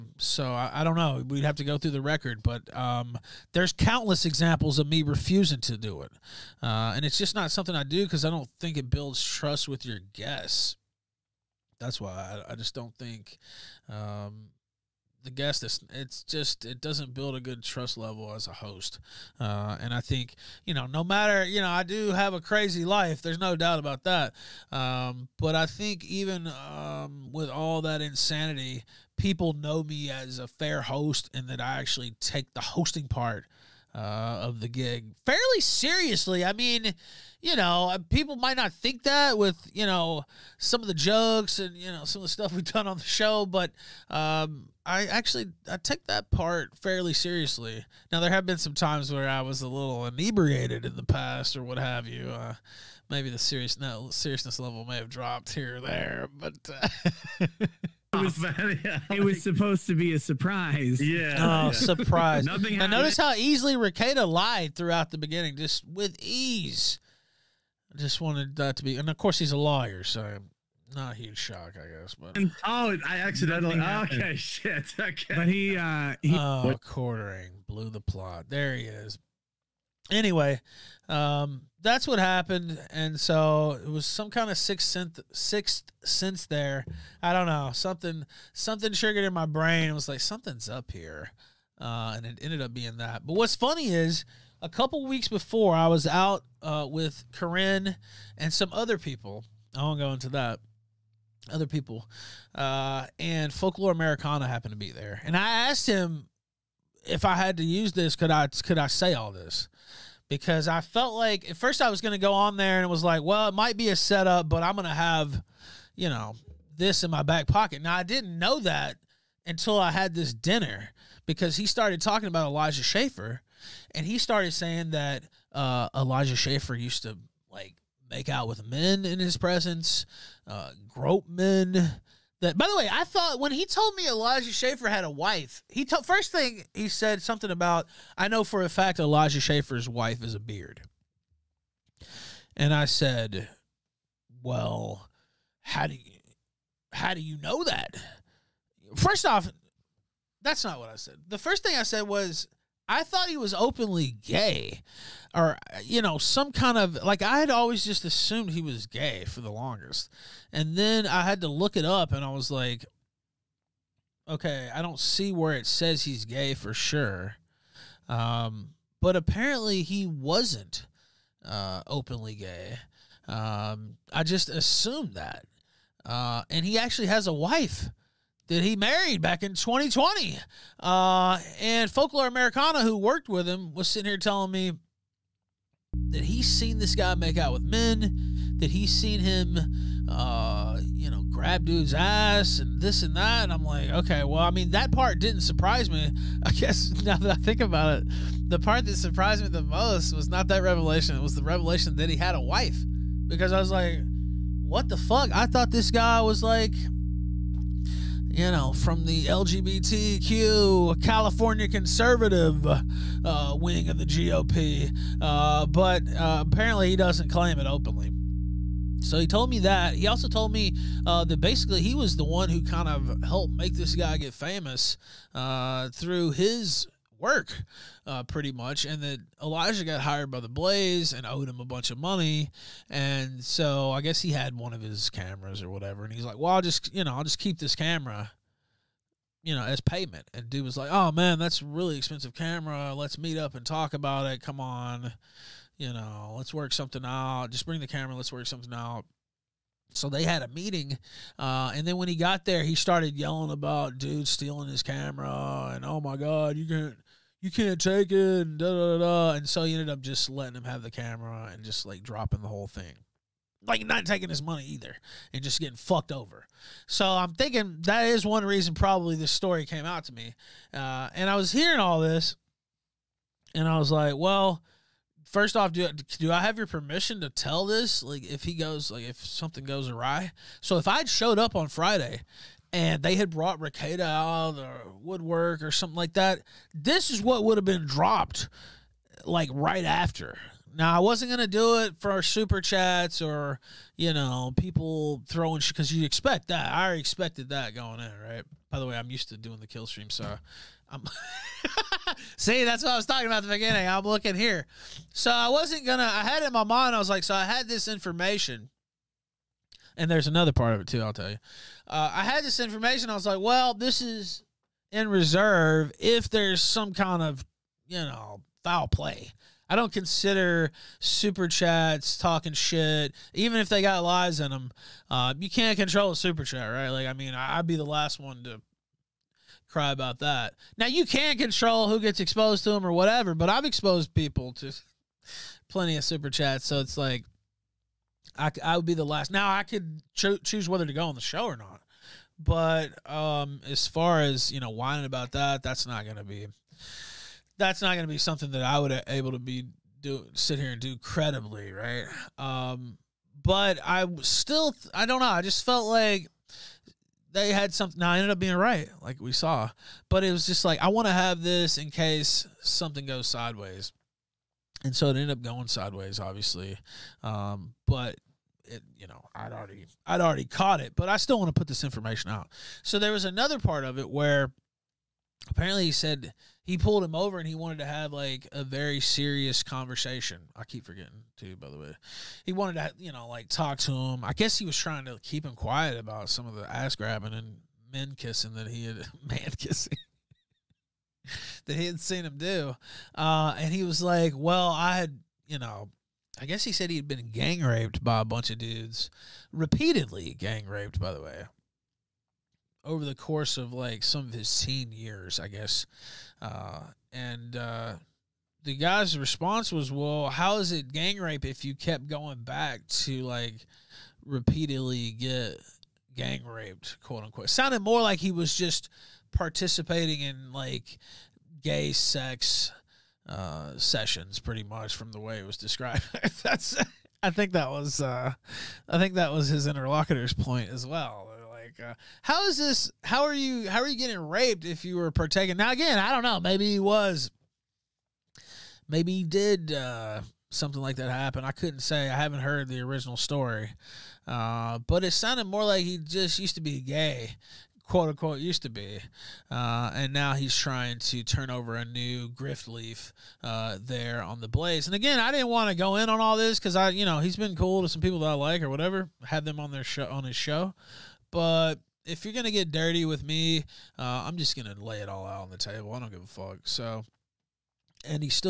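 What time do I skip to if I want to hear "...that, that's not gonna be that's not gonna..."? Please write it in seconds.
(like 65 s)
345 s.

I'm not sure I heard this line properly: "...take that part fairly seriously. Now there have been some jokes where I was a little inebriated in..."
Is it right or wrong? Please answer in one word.
wrong.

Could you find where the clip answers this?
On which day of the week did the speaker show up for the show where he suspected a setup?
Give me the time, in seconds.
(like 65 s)
281 s.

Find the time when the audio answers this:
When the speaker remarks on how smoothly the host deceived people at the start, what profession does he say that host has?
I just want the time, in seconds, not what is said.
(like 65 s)
69 s.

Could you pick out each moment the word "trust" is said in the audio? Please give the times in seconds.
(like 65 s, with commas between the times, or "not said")
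9 s, 17 s.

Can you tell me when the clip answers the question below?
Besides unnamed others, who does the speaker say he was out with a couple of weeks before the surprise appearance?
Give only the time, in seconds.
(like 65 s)
97 s.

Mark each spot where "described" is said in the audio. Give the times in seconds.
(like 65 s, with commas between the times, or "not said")
425 s.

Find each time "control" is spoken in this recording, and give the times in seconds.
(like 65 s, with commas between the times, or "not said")
325 s, 331 s.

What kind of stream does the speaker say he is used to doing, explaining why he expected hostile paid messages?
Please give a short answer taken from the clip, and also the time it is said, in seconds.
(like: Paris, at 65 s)
Kill stream, at 299 s.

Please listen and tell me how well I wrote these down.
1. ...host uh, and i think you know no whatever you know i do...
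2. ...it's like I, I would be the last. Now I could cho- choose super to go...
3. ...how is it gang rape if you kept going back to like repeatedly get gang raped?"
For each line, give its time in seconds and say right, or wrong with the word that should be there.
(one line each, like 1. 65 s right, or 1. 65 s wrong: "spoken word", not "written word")
1. 18 s wrong: "matter", not "whatever"
2. 336 s wrong: "whether", not "super"
3. 410 s right.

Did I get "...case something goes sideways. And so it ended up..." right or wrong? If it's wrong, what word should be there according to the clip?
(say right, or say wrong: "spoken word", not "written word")
right.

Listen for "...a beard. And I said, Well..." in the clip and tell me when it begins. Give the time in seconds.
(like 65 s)
140 s.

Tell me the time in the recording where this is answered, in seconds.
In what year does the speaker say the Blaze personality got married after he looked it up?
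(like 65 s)
179 s.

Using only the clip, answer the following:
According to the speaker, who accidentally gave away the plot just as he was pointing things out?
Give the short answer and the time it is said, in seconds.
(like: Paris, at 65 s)
Quartering, at 76 s.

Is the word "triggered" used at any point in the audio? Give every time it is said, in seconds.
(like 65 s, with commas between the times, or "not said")
88 s.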